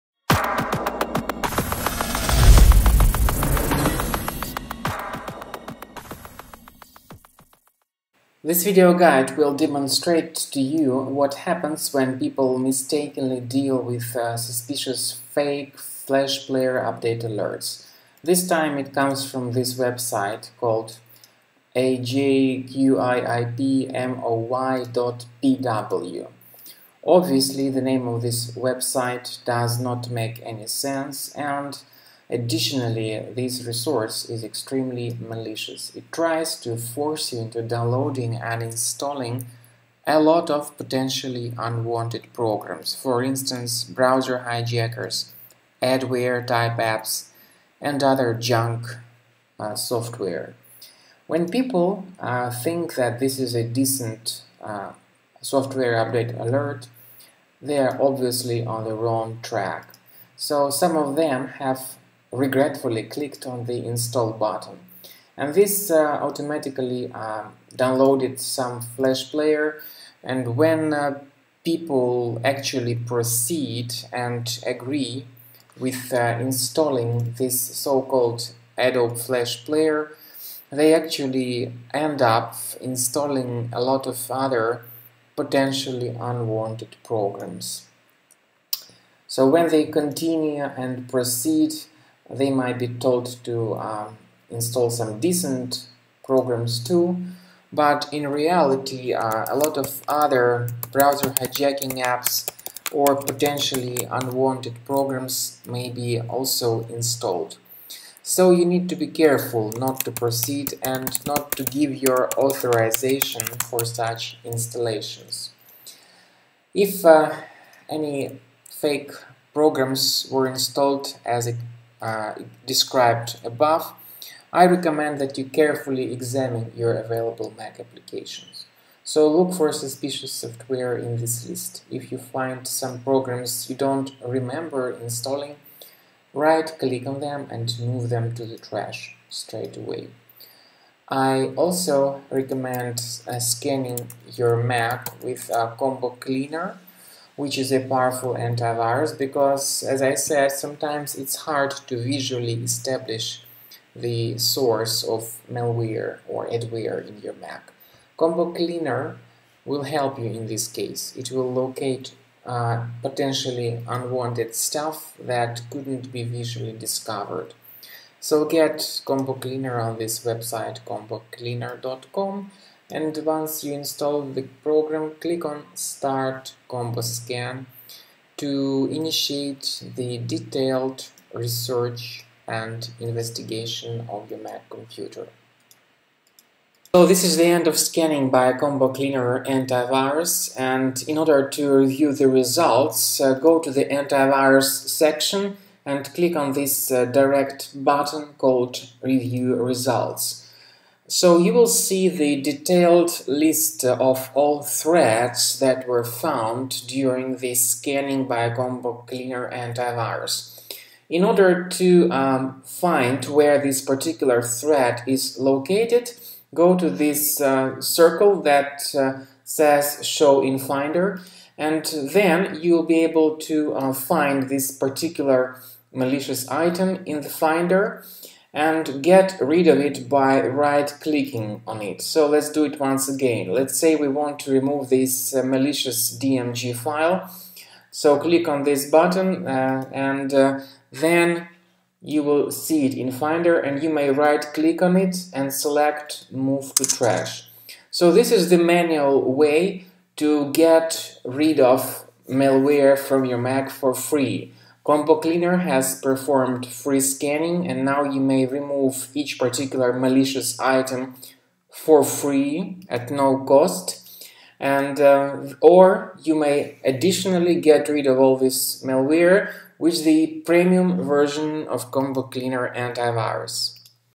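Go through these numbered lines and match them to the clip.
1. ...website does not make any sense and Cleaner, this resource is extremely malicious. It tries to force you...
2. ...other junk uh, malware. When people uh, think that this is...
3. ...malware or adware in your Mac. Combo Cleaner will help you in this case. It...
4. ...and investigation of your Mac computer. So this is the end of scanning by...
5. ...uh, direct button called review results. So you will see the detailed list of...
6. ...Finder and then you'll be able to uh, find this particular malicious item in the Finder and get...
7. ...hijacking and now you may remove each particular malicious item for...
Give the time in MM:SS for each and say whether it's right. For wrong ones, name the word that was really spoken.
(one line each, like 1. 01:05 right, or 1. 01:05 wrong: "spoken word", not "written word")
1. 00:28 wrong: "Additionally", not "Cleaner"
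2. 00:48 wrong: "software", not "malware"
3. 02:35 right
4. 03:02 right
5. 03:16 right
6. 03:40 right
7. 04:17 wrong: "scanning", not "hijacking".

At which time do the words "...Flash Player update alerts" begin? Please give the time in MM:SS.
00:15.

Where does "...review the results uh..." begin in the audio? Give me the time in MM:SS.
03:11.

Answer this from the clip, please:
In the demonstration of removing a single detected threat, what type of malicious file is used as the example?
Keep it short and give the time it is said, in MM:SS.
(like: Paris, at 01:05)
DMG file, at 03:56.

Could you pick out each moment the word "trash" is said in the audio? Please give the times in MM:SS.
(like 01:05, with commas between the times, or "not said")
02:18, 04:06.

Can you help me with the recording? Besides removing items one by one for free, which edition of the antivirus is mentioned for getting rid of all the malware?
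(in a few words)
premium version.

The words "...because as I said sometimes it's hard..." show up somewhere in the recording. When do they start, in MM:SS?
02:29.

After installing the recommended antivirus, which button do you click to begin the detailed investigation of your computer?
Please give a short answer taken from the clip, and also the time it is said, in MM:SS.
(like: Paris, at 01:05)
start Combo scan, at 02:55.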